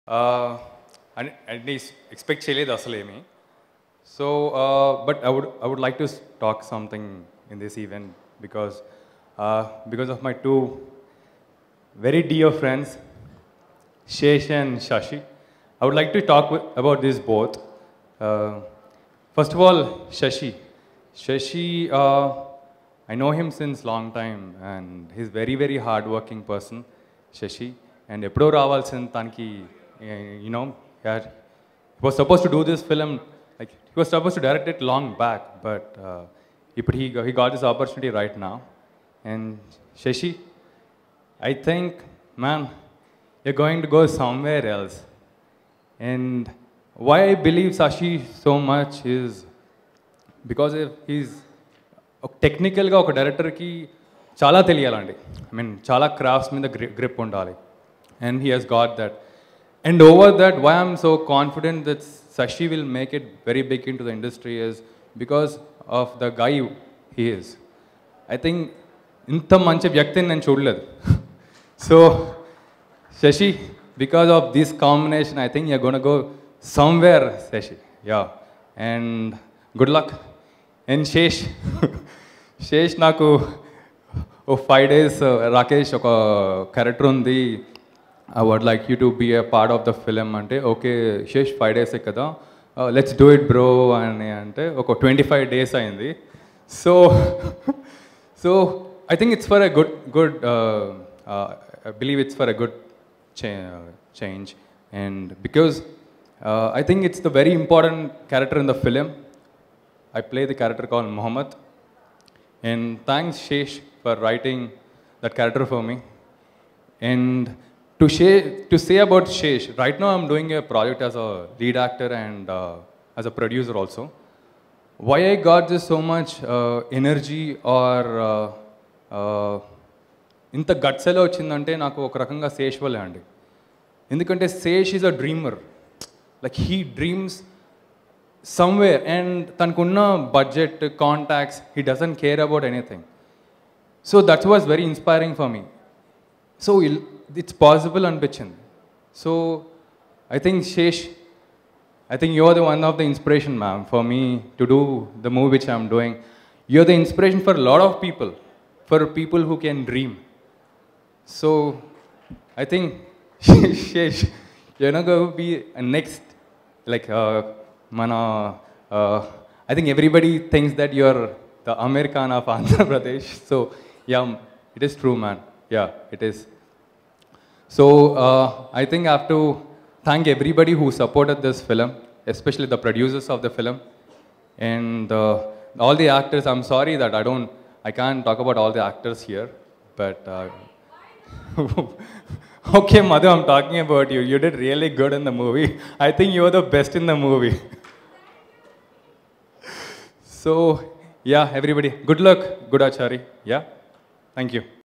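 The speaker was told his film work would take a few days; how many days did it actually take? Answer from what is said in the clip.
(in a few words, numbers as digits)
25.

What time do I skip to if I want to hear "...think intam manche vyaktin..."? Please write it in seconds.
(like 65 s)
68 s.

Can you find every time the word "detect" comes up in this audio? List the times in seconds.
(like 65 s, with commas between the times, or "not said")
not said.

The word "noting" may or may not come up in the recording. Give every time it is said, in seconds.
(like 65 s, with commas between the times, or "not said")
not said.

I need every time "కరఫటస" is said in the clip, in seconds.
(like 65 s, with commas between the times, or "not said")
56 s.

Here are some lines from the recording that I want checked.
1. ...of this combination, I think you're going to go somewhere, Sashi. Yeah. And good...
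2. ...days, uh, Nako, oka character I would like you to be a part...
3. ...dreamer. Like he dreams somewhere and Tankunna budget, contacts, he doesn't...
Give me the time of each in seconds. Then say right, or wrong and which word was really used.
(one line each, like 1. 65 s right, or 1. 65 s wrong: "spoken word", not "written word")
1. 74 s right
2. 84 s wrong: "Rakesh", not "Nako"
3. 135 s right.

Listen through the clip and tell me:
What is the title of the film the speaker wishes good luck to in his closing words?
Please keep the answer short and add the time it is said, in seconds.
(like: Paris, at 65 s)
Goodachari, at 202 s.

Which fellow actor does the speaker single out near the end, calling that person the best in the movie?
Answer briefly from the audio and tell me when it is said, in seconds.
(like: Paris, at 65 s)
Madhu, at 192 s.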